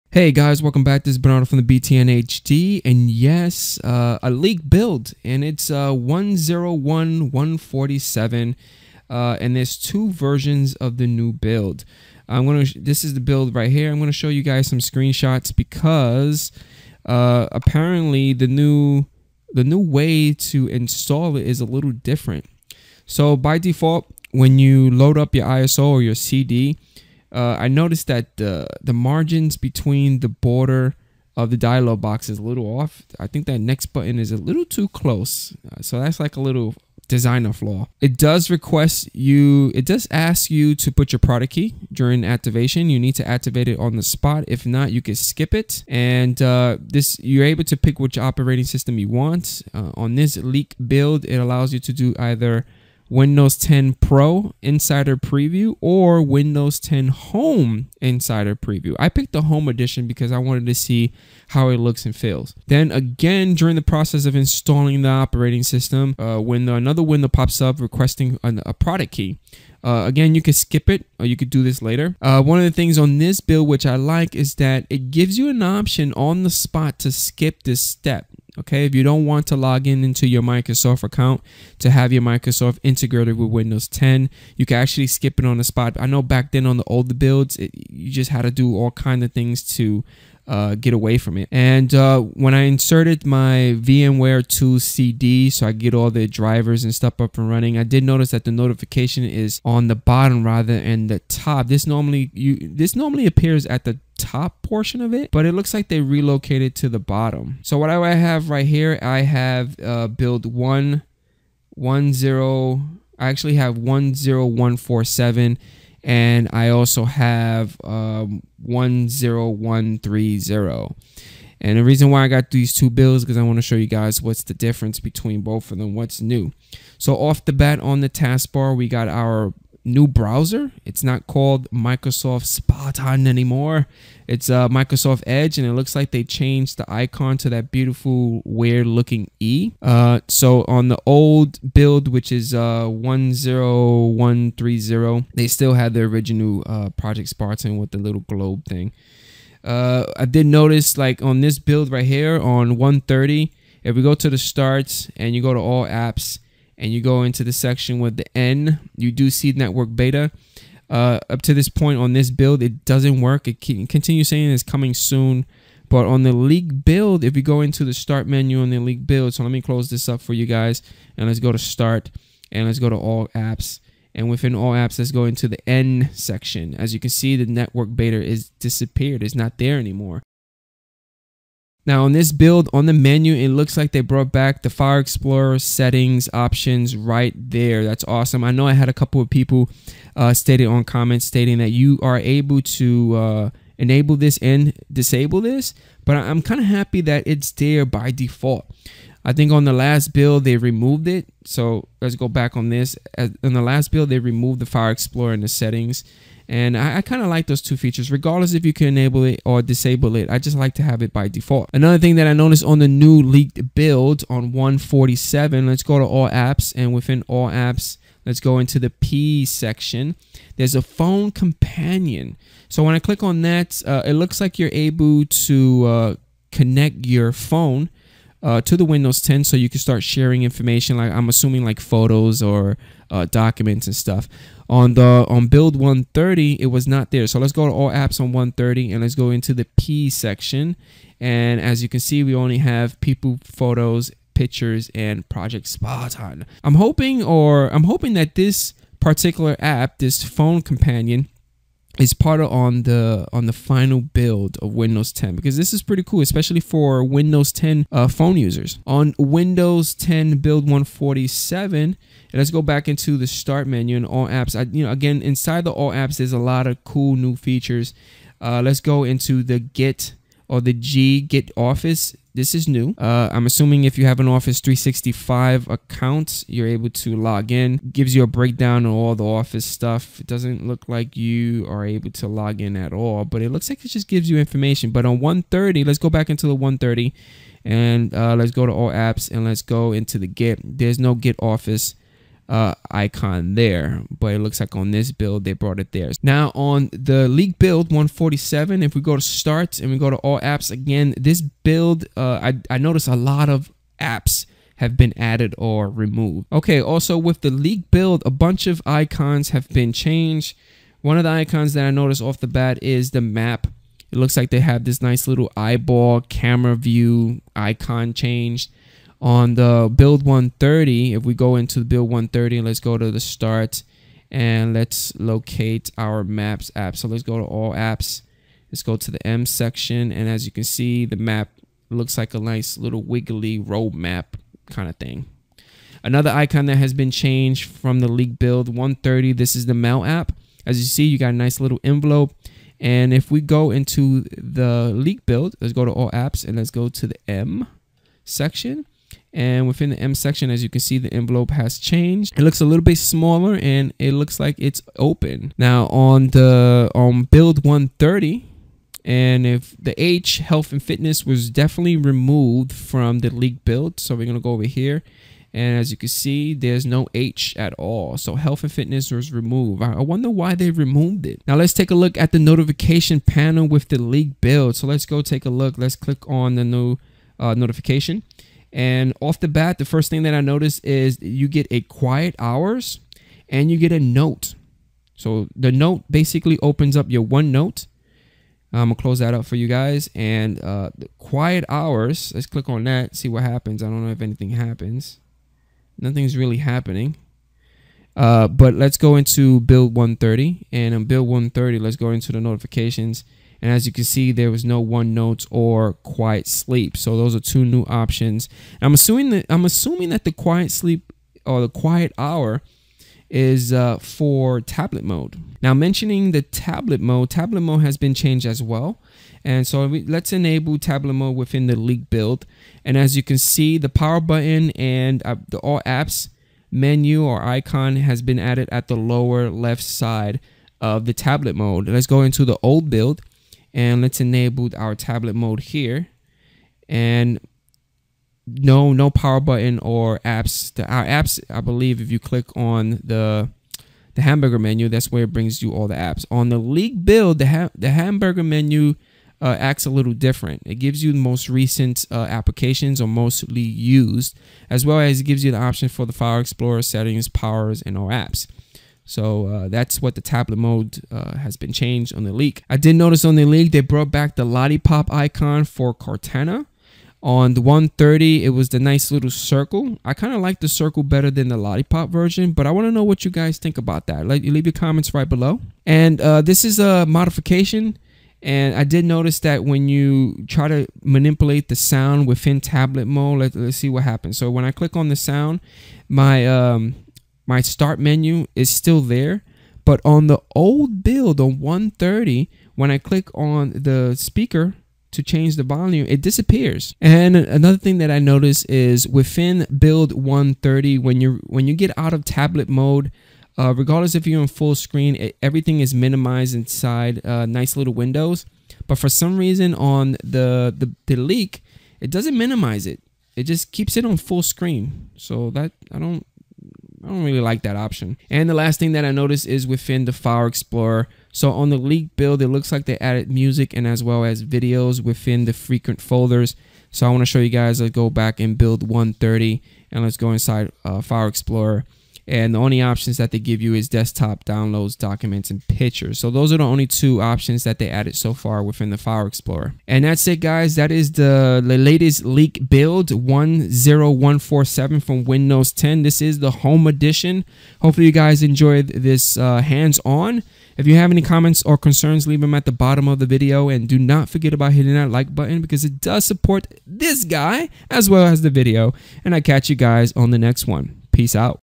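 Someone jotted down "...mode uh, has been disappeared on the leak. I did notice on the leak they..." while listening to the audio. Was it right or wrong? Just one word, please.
wrong.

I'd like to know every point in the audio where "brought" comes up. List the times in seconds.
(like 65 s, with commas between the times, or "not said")
184 s, 295 s, 463 s.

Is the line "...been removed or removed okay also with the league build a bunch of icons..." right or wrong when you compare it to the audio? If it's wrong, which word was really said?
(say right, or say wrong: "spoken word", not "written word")
wrong: "added", not "removed".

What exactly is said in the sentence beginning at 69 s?
Uh, again, you could skip it or you could do this later.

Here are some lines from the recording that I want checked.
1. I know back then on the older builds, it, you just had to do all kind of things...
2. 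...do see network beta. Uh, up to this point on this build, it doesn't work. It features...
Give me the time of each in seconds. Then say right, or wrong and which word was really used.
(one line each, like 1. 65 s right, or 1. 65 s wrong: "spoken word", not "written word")
1. 85 s right
2. 159 s wrong: "continues", not "features".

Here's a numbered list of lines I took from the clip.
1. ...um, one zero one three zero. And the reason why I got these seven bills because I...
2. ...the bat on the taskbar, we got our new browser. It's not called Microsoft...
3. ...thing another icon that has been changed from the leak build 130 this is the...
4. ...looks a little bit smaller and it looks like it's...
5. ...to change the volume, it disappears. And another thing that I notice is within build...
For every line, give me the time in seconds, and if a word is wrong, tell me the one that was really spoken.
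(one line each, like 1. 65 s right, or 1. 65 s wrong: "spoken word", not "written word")
1. 117 s wrong: "two", not "seven"
2. 127 s right
3. 334 s right
4. 352 s right
5. 495 s right.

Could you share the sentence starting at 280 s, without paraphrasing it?
It doesn't look like you are able to log in at all, but it looks like it just gives you information.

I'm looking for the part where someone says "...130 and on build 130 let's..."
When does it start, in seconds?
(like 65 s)
399 s.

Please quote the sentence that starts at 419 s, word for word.
And so we, let's enable tablet mode within the leak build.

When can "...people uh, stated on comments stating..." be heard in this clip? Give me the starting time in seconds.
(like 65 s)
189 s.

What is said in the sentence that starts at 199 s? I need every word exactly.
I think on the last build they removed it.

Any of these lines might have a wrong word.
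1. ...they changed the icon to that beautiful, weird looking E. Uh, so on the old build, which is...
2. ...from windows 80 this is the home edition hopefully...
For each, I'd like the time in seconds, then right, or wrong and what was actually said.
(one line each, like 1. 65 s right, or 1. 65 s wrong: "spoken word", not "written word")
1. 136 s right
2. 545 s wrong: "10", not "80".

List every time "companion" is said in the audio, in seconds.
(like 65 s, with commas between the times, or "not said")
221 s, 250 s.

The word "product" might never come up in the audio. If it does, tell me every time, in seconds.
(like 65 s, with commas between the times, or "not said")
41 s, 68 s.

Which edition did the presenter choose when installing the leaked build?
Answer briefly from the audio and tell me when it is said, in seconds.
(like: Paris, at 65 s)
Windows 10 Home Insider Preview, at 56 s.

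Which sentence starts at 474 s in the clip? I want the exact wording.
Like, leave your comments right below.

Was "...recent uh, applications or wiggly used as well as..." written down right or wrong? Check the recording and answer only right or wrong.
wrong.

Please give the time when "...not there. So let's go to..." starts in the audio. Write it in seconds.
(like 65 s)
236 s.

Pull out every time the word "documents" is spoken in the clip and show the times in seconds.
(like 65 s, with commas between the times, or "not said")
233 s, 534 s.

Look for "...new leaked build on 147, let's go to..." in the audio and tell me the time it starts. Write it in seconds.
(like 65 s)
212 s.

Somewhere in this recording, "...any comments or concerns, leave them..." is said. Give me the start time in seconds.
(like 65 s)
551 s.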